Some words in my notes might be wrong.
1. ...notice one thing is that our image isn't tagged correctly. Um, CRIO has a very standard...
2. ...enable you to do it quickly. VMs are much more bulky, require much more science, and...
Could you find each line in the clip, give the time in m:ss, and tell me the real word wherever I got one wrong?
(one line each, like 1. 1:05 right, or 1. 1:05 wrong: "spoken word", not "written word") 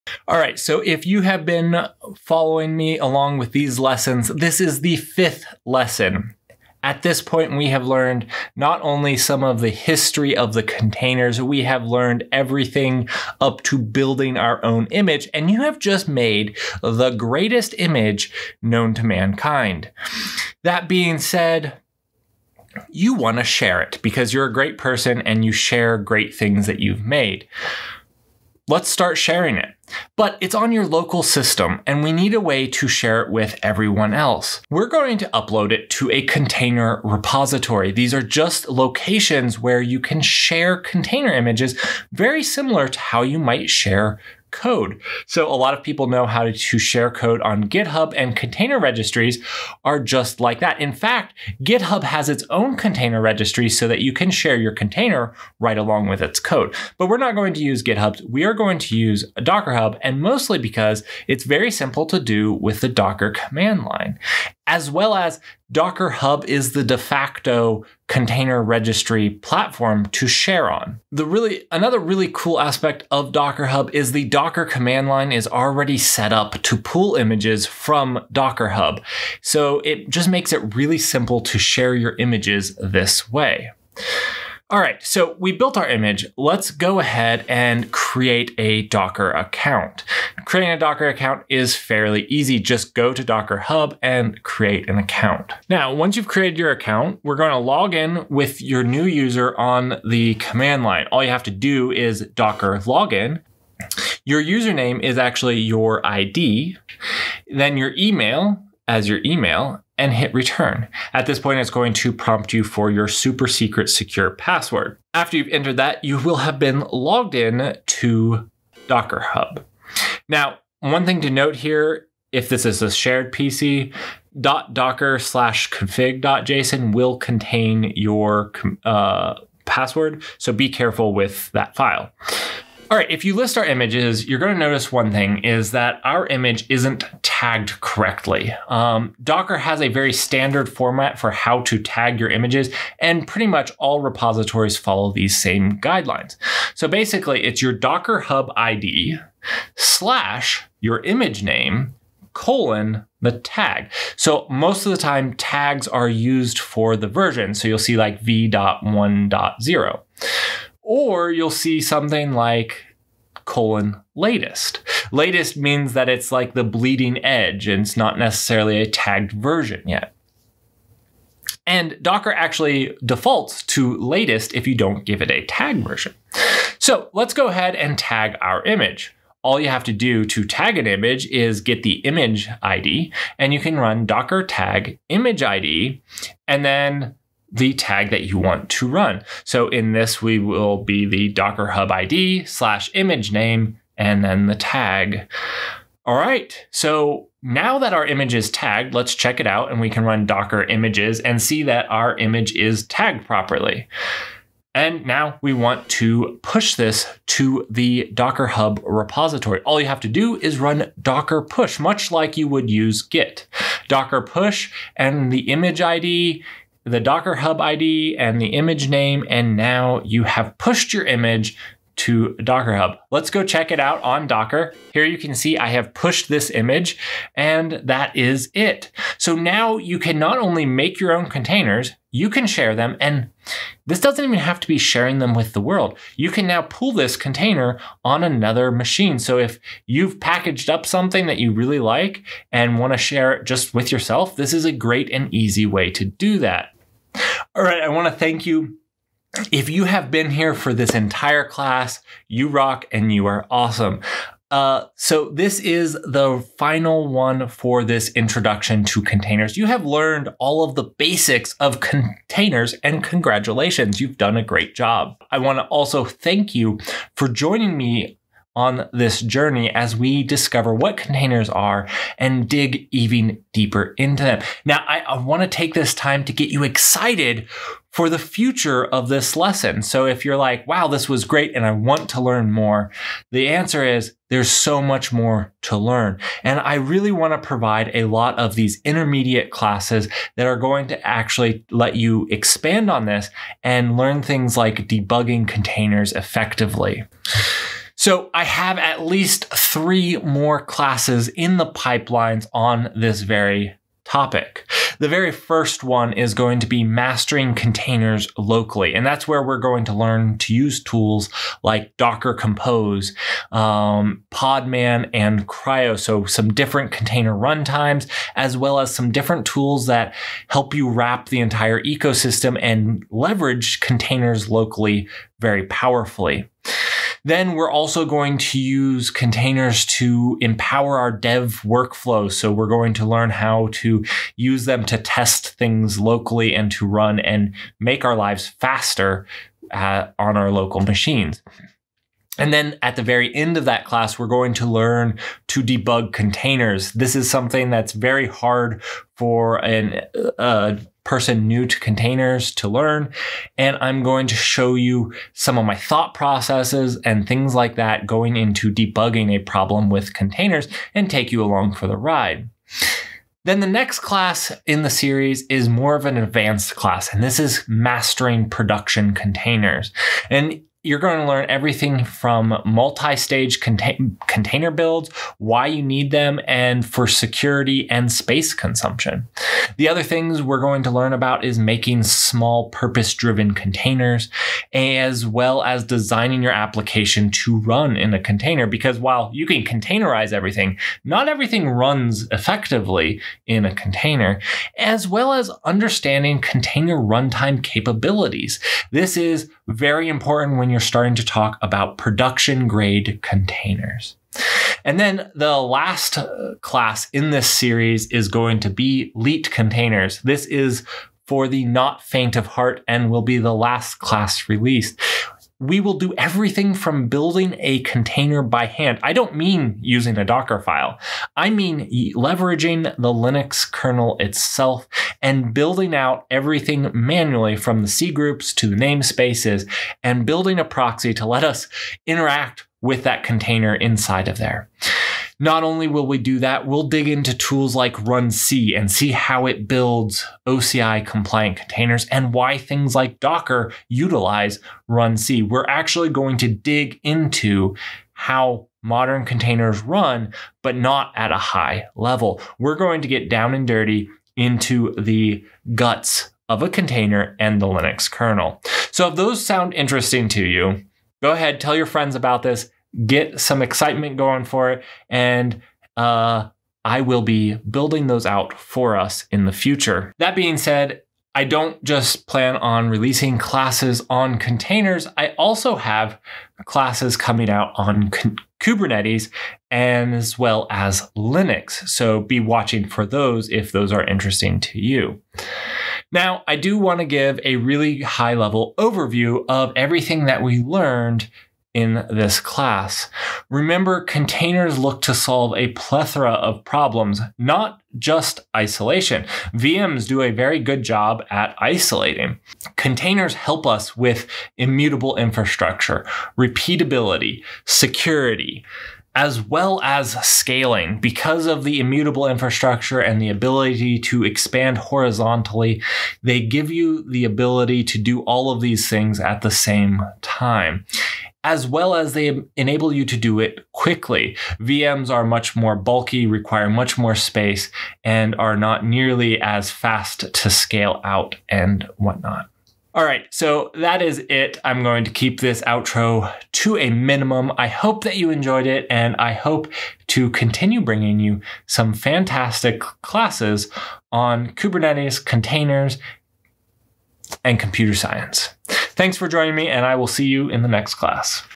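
1. 2:14 wrong: "Docker", not "CRIO"
2. 8:42 wrong: "space", not "science".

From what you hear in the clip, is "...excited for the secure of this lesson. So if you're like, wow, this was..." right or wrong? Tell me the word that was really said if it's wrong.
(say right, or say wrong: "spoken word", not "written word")
wrong: "future", not "secure".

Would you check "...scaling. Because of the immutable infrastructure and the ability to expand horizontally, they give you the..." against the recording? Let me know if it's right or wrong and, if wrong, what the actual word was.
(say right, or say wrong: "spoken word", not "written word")
right.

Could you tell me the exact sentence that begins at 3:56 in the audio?
You can now pull this container on another machine.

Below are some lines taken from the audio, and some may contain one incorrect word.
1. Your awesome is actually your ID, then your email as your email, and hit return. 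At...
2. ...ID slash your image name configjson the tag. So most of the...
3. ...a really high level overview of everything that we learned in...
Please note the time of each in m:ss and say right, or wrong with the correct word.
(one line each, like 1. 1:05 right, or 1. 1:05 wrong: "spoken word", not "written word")
1. 1:44 wrong: "username", not "awesome"
2. 2:28 wrong: "colon", not "configjson"
3. 8:07 right.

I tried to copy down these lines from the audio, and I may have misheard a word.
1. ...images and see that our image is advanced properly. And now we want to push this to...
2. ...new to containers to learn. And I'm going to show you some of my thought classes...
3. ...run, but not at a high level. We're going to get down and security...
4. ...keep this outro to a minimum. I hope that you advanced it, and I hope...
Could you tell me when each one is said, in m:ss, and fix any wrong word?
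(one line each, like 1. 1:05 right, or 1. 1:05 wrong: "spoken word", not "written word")
1. 3:20 wrong: "tagged", not "advanced"
2. 5:51 wrong: "processes", not "classes"
3. 7:29 wrong: "dirty", not "security"
4. 8:55 wrong: "enjoyed", not "advanced".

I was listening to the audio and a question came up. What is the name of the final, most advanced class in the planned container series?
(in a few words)
Leet containers.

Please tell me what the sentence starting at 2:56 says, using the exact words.
So let's go ahead and tag our image.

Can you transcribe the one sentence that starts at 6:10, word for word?
And you're going to learn everything from multi-stage contain container builds, why you need them, and for security and space consumption.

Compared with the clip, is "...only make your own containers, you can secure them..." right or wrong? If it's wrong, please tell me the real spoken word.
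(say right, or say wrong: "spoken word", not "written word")
wrong: "share", not "secure".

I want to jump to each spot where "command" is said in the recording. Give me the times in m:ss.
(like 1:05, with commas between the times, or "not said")
1:03, 1:14, 1:40.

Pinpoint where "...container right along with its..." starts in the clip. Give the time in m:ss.
0:54.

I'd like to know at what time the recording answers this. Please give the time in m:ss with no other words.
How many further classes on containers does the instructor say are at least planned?
4:59.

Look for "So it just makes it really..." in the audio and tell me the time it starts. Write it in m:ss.
1:19.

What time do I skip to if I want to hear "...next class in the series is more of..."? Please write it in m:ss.
6:03.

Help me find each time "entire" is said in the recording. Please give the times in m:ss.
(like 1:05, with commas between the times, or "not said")
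4:10, 5:21.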